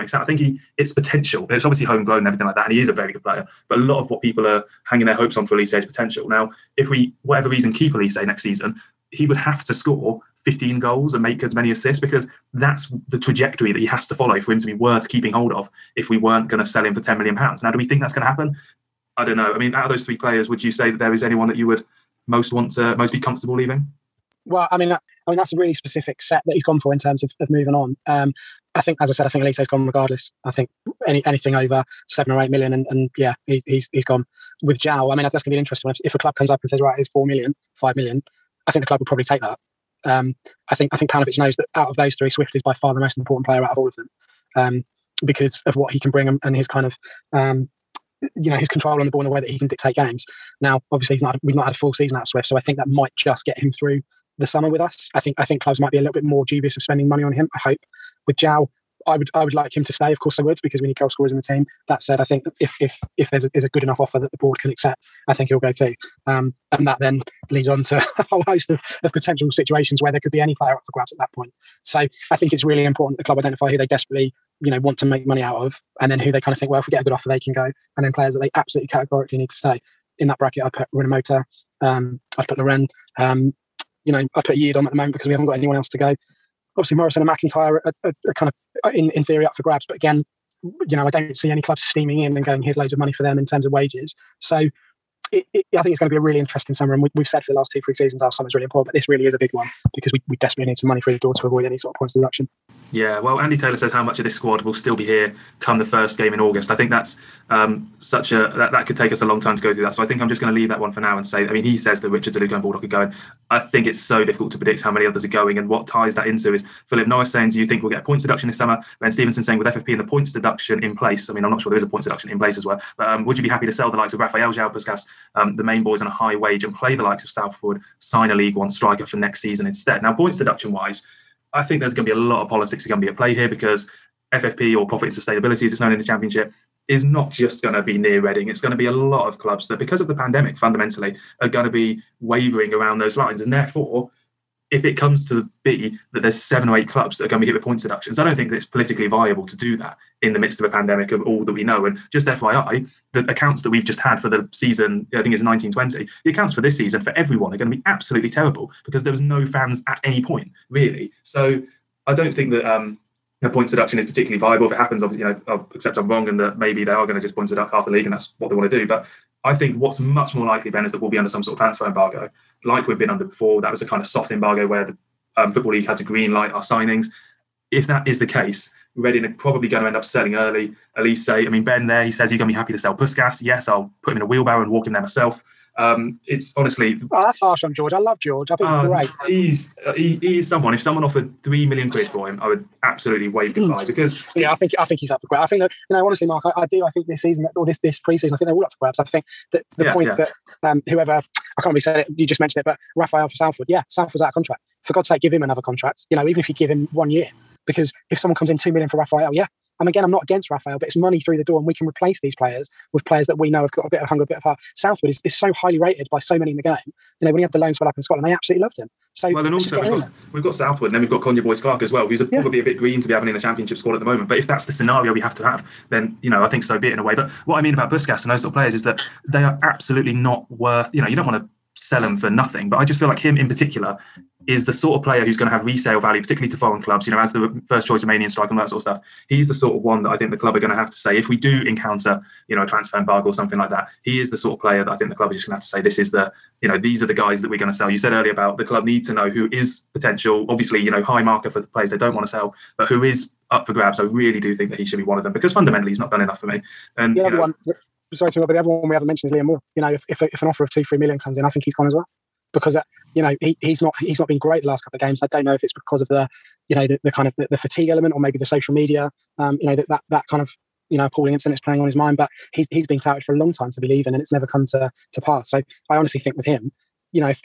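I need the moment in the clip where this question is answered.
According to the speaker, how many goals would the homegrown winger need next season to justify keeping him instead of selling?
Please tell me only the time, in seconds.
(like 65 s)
10 s.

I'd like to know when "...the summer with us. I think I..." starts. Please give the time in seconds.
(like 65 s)
54 s.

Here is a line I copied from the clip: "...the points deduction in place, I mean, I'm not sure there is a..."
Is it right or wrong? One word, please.
right.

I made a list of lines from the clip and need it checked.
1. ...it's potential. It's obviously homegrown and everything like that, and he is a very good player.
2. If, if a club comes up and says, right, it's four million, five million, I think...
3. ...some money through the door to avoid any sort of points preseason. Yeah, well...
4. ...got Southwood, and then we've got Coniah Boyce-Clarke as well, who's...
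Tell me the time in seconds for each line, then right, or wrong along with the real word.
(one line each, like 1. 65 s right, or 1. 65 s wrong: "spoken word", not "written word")
1. 0 s right
2. 35 s right
3. 100 s wrong: "deduction", not "preseason"
4. 220 s right.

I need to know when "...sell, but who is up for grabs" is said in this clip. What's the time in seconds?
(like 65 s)
252 s.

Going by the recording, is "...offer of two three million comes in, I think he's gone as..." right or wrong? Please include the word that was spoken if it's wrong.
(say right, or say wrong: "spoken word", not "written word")
right.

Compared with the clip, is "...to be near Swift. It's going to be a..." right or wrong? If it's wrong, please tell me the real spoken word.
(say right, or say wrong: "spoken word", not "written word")
wrong: "Reading", not "Swift".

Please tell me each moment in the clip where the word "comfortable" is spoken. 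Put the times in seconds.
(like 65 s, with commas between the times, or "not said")
23 s.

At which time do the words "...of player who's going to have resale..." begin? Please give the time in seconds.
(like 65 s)
234 s.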